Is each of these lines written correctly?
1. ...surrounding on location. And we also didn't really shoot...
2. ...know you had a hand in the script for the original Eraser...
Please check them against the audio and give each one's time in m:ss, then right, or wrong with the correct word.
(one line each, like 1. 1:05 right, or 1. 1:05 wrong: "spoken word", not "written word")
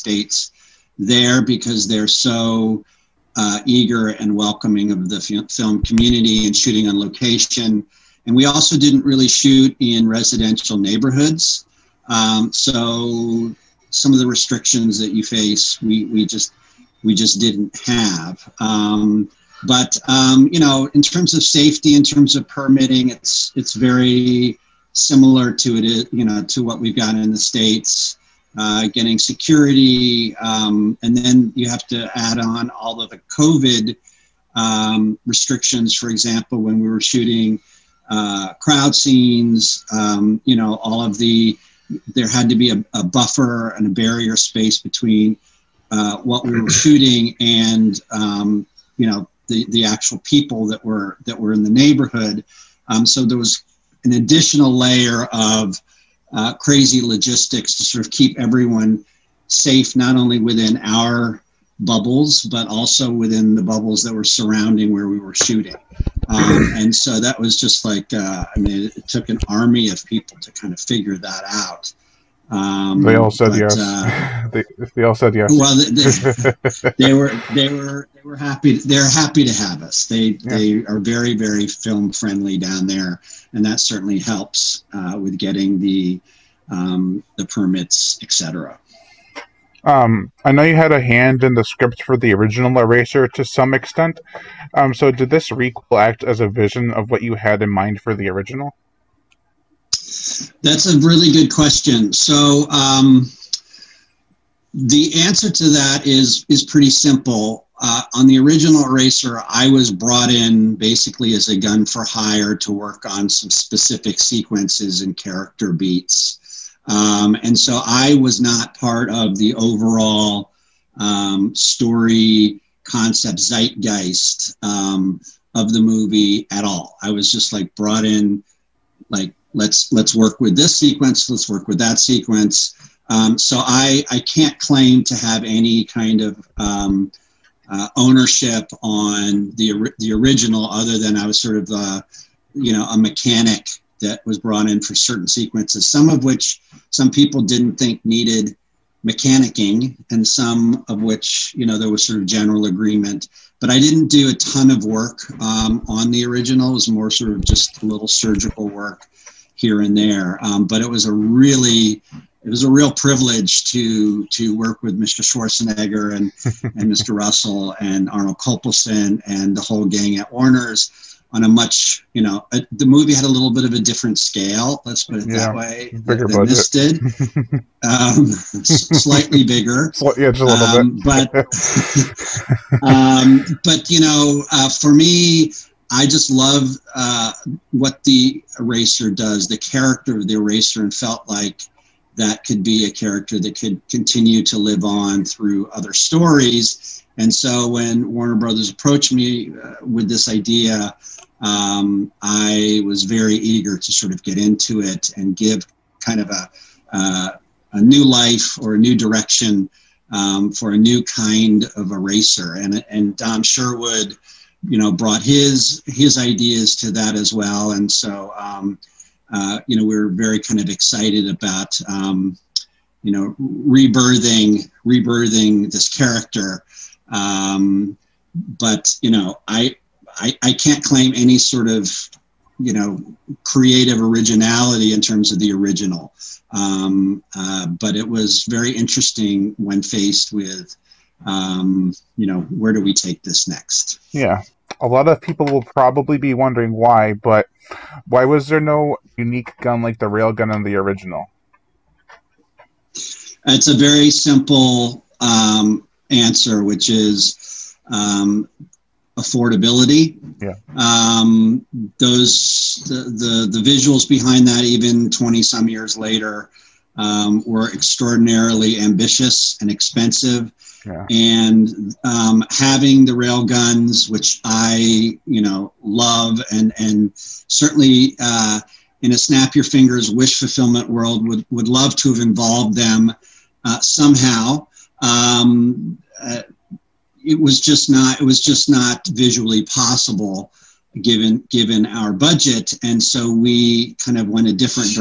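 1. 0:06 wrong: "shooting", not "surrounding"
2. 1:30 right.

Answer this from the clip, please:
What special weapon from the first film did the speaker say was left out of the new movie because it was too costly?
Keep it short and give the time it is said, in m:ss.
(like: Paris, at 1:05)
railgun, at 4:10.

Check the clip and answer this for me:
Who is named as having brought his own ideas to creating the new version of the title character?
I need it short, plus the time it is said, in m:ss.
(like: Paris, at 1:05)
Dom Sherwood, at 3:33.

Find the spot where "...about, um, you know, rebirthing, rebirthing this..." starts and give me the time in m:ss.
3:41.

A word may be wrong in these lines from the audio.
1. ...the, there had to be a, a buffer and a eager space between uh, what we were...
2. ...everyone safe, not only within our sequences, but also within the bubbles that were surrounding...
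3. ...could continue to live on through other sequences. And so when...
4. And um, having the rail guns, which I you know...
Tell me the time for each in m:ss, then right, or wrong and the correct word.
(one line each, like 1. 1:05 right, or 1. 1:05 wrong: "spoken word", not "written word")
1. 0:41 wrong: "barrier", not "eager"
2. 0:58 wrong: "bubbles", not "sequences"
3. 3:13 wrong: "stories", not "sequences"
4. 4:31 right.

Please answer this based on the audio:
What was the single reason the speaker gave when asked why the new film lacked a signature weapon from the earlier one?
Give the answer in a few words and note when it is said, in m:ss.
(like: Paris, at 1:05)
affordability, at 4:19.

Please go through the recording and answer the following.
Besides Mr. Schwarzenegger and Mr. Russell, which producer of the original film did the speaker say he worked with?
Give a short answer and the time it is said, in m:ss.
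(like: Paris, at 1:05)
Arnold Kopelson, at 2:48.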